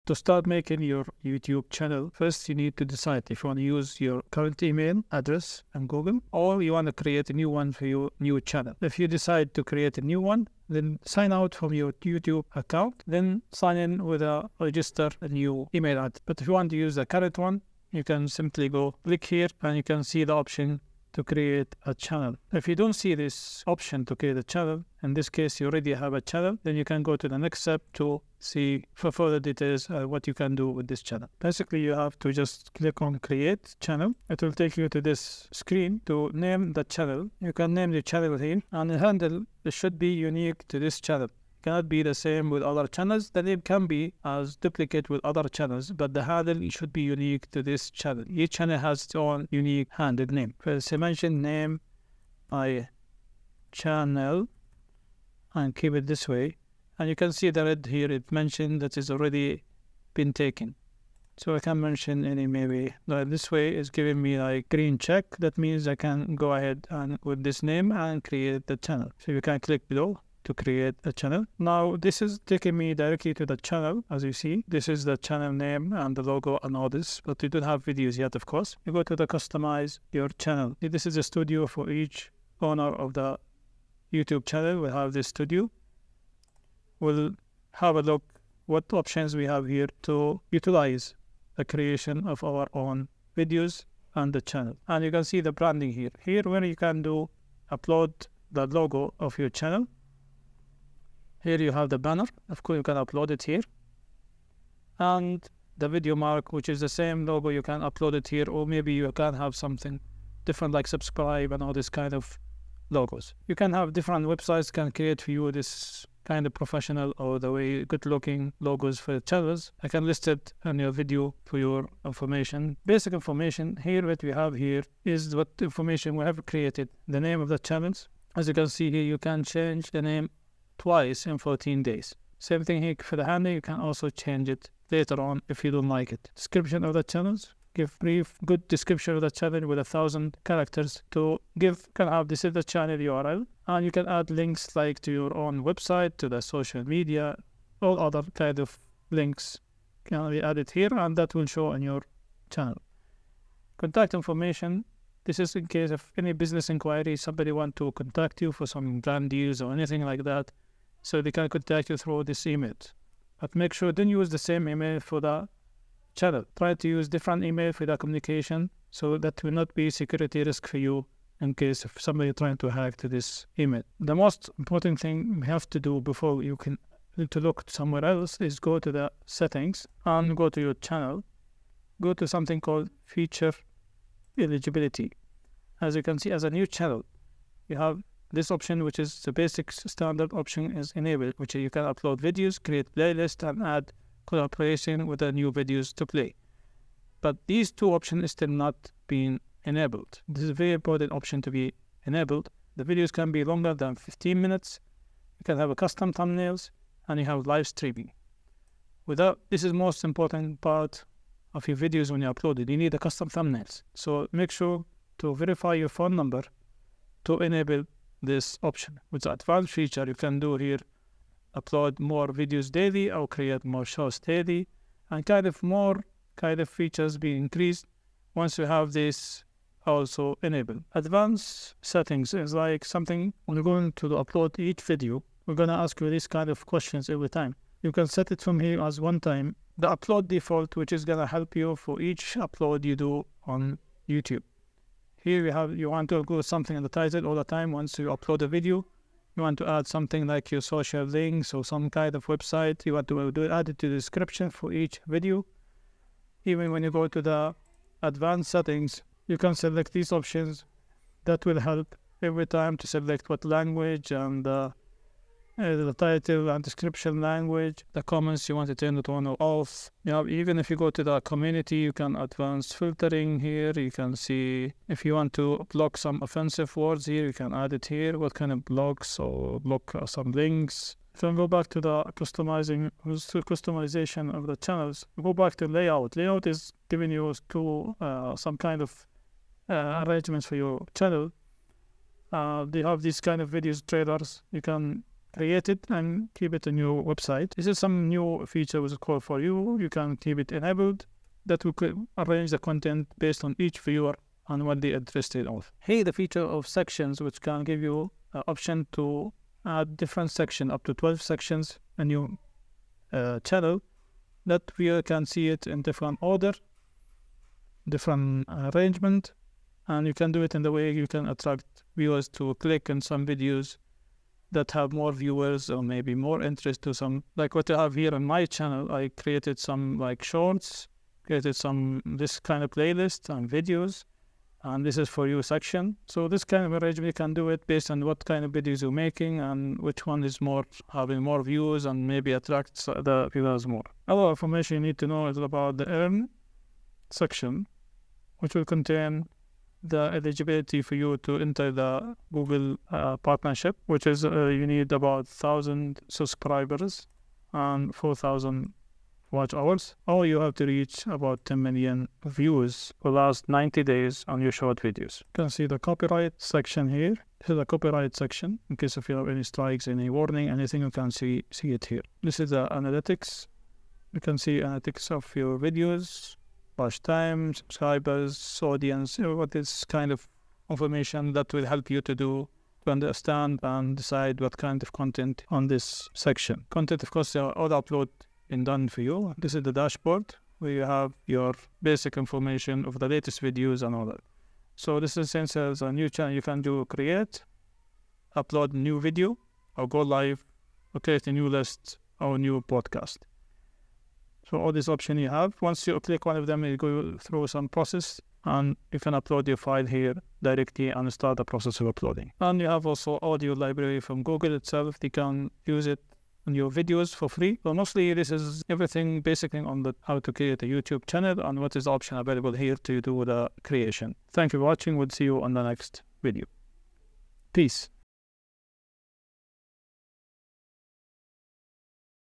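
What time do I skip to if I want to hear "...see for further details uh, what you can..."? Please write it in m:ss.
0:28.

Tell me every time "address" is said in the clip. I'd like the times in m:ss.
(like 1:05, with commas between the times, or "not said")
0:05, 0:15.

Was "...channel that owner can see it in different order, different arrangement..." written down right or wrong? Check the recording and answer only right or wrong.
wrong.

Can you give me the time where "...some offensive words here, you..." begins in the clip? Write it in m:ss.
4:35.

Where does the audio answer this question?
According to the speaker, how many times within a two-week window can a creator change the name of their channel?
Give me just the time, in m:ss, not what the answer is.
2:10.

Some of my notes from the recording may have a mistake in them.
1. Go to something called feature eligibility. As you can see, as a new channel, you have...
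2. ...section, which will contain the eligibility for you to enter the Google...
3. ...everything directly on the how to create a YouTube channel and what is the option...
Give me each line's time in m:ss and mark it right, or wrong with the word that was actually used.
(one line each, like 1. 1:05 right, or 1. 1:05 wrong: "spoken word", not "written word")
1. 3:02 right
2. 5:47 right
3. 6:58 wrong: "basically", not "directly".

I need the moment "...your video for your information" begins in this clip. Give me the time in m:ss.
2:00.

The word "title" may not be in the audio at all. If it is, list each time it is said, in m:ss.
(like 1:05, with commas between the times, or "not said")
4:06, 4:25.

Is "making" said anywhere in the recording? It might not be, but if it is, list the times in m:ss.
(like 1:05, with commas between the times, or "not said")
0:00, 5:38.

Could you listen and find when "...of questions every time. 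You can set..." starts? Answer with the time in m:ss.
3:56.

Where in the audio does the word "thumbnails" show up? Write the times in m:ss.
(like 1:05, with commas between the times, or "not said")
3:26, 3:33.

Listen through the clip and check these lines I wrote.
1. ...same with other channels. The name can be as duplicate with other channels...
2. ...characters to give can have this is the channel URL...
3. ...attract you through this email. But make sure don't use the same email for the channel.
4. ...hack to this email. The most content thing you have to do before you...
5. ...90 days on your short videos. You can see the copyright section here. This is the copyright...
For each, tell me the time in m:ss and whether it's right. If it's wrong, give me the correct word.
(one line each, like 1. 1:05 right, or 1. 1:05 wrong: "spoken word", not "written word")
1. 0:42 right
2. 2:20 right
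3. 2:41 wrong: "contact", not "attract"
4. 2:52 wrong: "important", not "content"
5. 6:03 right.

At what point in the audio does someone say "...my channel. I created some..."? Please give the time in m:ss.
5:28.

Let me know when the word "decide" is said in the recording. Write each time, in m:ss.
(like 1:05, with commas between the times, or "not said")
0:02, 0:09, 6:23.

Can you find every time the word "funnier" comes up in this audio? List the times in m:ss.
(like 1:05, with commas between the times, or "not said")
not said.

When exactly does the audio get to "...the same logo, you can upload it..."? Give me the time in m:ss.
1:46.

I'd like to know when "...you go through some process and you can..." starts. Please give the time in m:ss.
6:46.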